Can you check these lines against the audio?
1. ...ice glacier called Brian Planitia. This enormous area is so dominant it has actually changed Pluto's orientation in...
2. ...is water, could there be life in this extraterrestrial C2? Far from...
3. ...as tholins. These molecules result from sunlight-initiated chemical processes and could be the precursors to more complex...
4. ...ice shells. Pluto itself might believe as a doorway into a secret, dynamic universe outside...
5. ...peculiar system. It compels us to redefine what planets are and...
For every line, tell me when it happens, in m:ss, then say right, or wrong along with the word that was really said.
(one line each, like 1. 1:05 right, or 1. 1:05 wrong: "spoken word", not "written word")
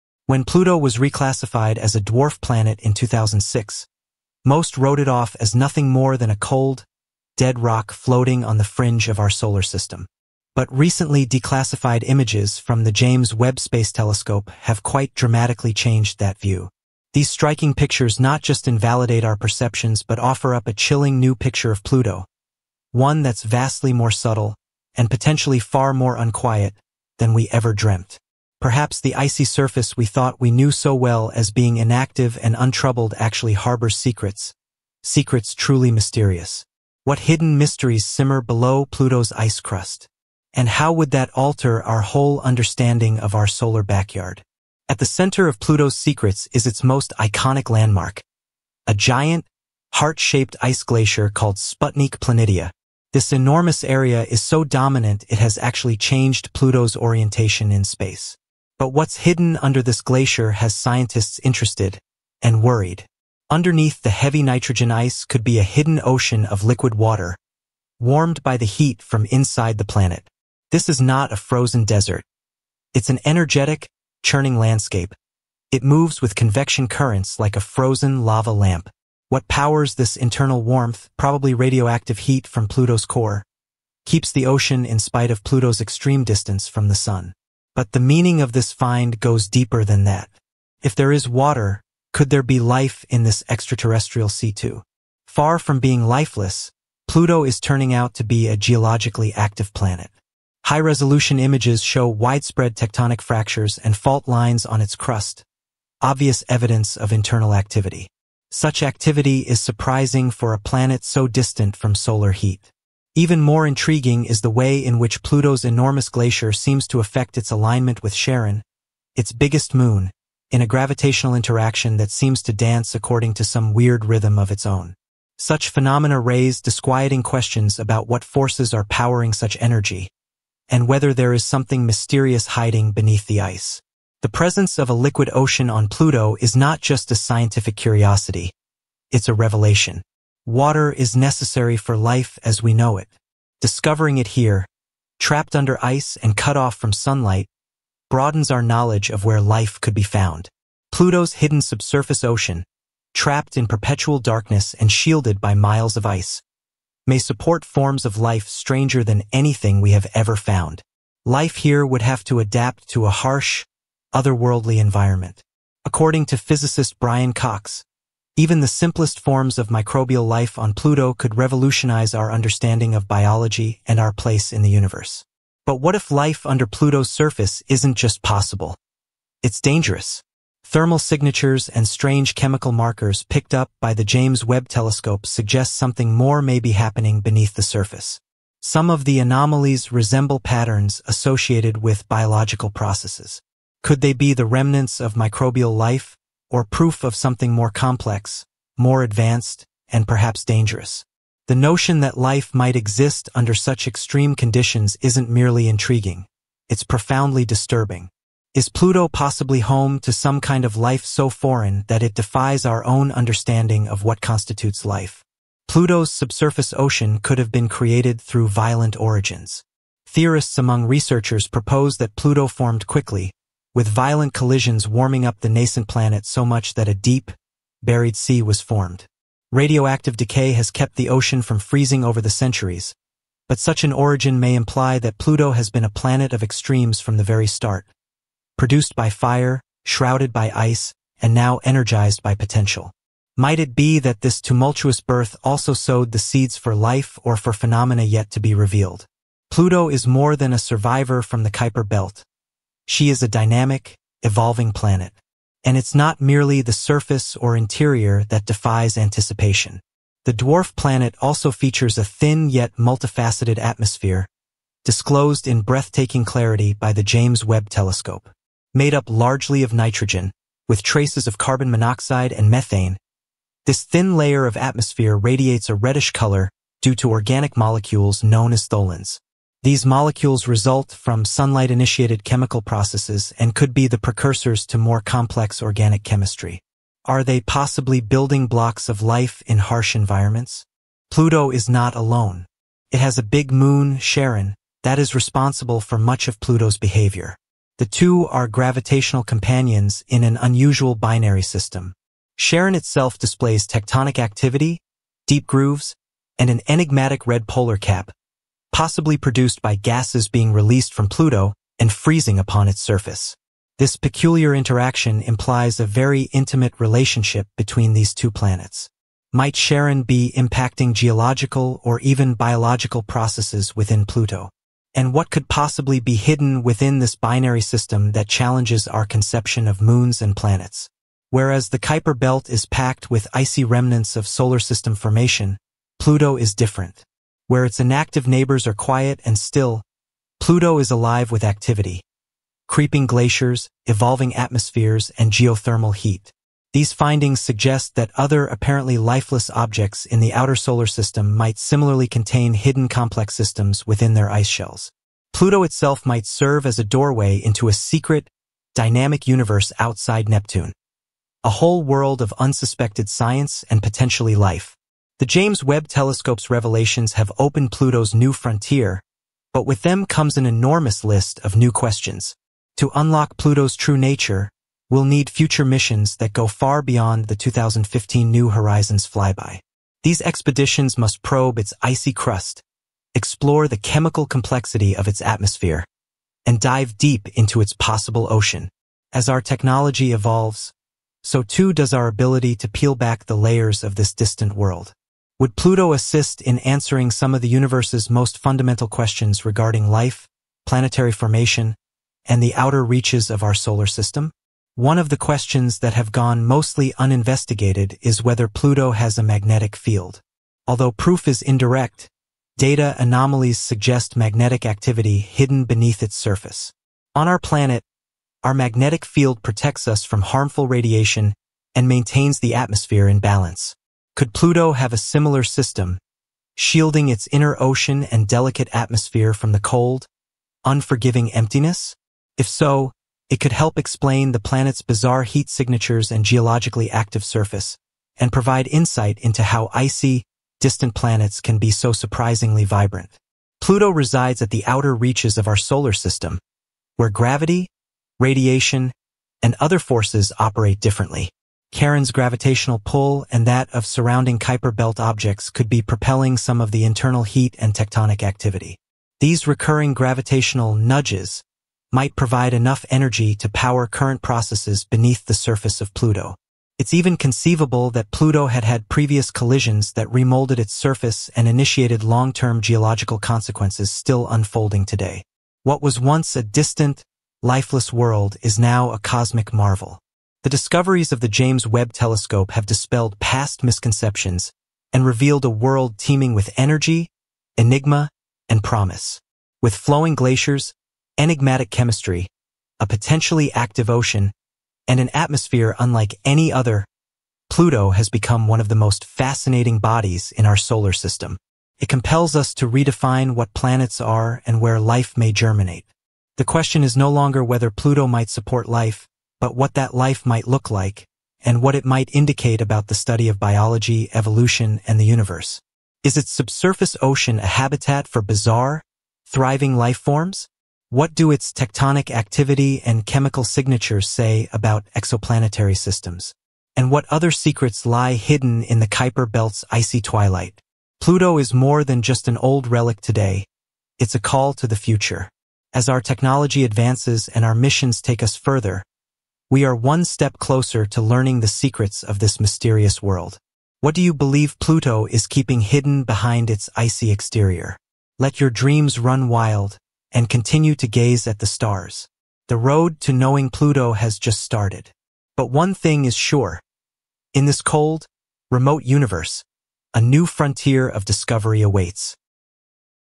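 1. 0:50 wrong: "Sputnik", not "Brian"
2. 1:31 right
3. 4:38 right
4. 5:54 wrong: "serve", not "believe"
5. 8:20 wrong: "solar", not "peculiar".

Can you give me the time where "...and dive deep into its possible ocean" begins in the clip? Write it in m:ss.
6:26.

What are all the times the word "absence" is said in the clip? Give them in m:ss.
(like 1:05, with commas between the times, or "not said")
not said.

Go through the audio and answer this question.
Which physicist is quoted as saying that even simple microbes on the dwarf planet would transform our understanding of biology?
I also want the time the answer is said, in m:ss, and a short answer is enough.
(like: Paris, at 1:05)
Brian Cox, at 2:46.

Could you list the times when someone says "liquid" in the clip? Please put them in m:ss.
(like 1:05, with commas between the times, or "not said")
1:06, 2:14.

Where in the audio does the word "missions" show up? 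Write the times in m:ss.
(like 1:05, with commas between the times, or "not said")
6:15, 8:57.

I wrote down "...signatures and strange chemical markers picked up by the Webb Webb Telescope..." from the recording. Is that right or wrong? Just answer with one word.
wrong.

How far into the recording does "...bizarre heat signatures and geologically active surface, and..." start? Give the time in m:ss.
7:14.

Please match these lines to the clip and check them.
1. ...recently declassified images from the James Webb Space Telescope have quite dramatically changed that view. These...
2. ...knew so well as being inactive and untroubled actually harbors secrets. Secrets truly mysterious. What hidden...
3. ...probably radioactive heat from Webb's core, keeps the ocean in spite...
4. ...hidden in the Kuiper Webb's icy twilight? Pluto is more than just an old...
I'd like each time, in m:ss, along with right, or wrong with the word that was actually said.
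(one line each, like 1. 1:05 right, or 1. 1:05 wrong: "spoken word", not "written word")
1. 0:10 right
2. 0:30 right
3. 1:21 wrong: "Pluto", not "Webb"
4. 8:48 wrong: "Belt", not "Webb".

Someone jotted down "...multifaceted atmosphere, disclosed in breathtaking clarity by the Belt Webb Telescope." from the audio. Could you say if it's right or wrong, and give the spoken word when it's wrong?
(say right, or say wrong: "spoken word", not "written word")
wrong: "James", not "Belt".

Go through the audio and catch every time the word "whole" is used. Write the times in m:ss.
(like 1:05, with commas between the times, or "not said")
0:42, 6:01.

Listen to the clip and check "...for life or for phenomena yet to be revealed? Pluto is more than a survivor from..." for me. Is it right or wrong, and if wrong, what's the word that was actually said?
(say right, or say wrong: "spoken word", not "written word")
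right.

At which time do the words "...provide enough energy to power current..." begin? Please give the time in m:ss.
7:42.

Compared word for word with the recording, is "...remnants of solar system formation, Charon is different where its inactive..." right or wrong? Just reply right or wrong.
wrong.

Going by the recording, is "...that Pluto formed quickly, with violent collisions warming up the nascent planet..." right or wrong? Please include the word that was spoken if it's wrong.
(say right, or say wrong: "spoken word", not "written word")
right.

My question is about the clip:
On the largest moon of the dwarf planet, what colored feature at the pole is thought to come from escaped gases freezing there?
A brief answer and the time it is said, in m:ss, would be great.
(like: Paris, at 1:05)
red polar cap, at 5:07.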